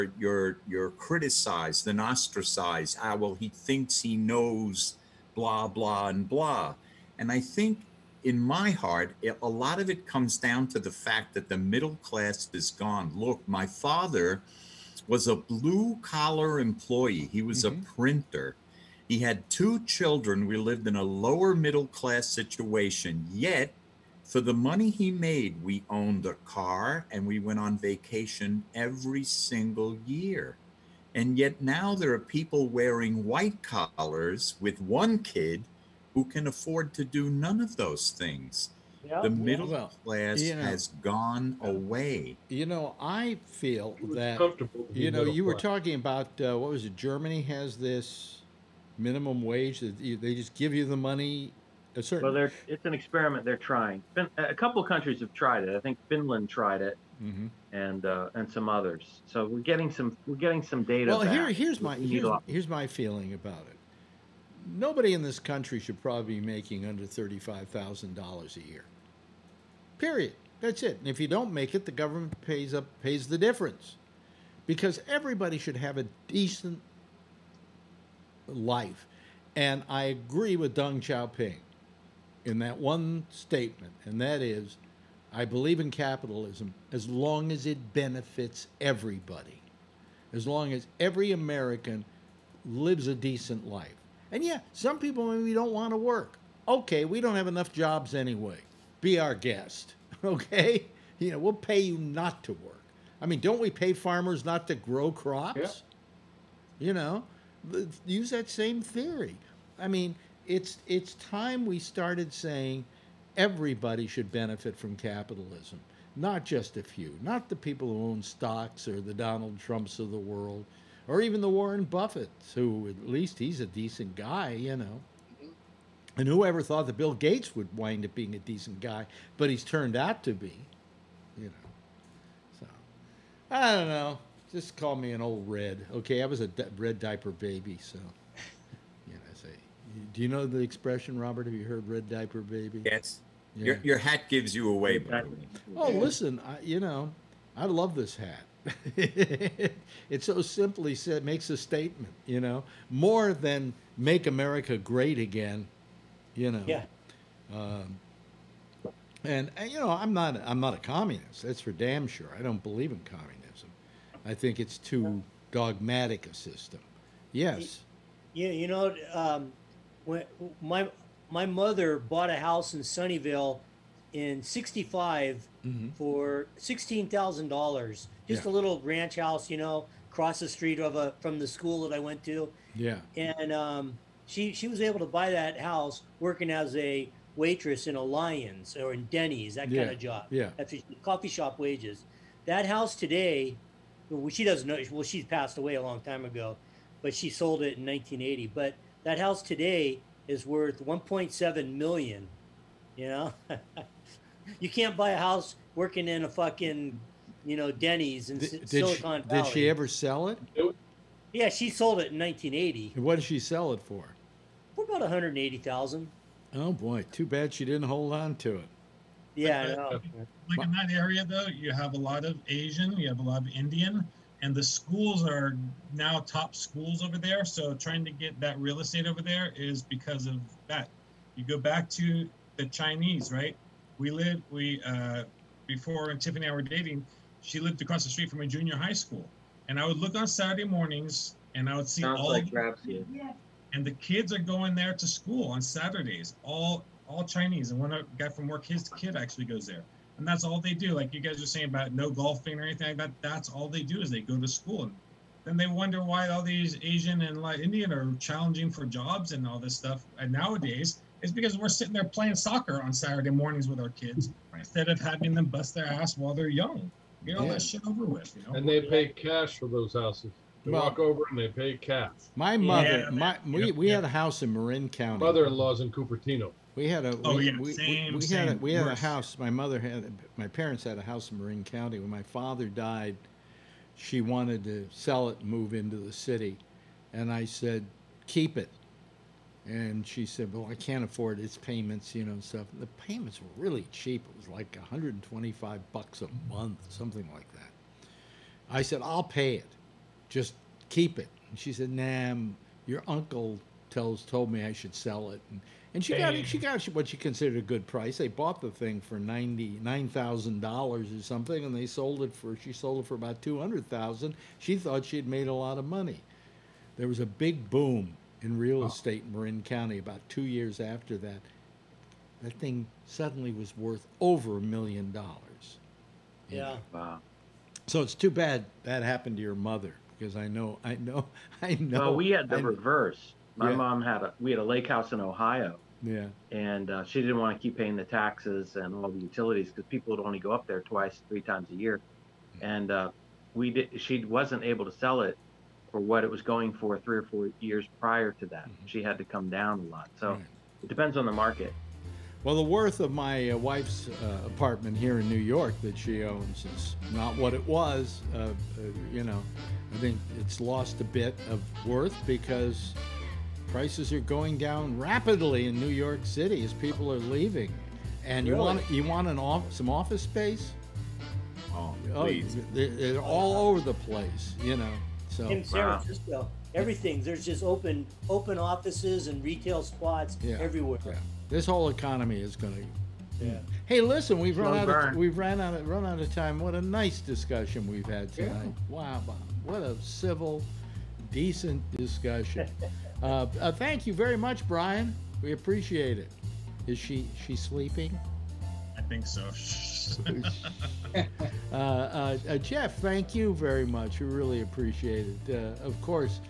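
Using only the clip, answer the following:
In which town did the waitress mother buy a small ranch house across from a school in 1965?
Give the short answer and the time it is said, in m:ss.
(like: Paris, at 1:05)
Sunnyvale, at 2:52.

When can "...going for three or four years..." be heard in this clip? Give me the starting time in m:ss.
5:46.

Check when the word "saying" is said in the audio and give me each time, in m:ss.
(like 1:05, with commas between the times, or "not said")
1:52, 4:11.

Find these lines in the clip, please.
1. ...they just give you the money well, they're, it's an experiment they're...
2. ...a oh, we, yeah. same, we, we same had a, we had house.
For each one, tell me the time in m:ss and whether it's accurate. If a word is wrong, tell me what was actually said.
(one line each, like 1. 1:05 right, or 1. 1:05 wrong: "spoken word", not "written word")
1. 0:49 right
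2. 4:37 wrong: "worse", not "house".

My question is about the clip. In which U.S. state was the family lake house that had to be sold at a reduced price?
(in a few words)
Ohio.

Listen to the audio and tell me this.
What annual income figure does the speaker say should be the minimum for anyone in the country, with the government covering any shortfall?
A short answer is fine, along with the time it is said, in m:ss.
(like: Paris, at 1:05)
$35,000, at 1:07.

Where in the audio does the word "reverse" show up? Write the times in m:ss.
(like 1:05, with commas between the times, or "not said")
5:32.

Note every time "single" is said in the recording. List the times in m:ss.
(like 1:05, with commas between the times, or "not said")
0:29.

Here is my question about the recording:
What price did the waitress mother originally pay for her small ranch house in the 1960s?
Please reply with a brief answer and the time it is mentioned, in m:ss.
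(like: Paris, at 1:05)
$16,000, at 2:56.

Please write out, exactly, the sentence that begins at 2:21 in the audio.
Have you heard "red diaper baby"?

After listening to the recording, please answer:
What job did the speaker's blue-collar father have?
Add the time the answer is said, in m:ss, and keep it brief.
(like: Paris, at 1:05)
Printer, at 0:17.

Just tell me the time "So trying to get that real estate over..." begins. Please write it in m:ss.
3:47.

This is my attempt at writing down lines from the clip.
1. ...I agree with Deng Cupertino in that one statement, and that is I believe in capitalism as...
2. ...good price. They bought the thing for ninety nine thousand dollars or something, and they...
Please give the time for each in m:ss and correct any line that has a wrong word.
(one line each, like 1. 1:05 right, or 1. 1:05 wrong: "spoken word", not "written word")
1. 1:19 wrong: "Xiaoping", not "Cupertino"
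2. 5:07 right.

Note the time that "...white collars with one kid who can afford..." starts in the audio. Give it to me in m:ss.
0:33.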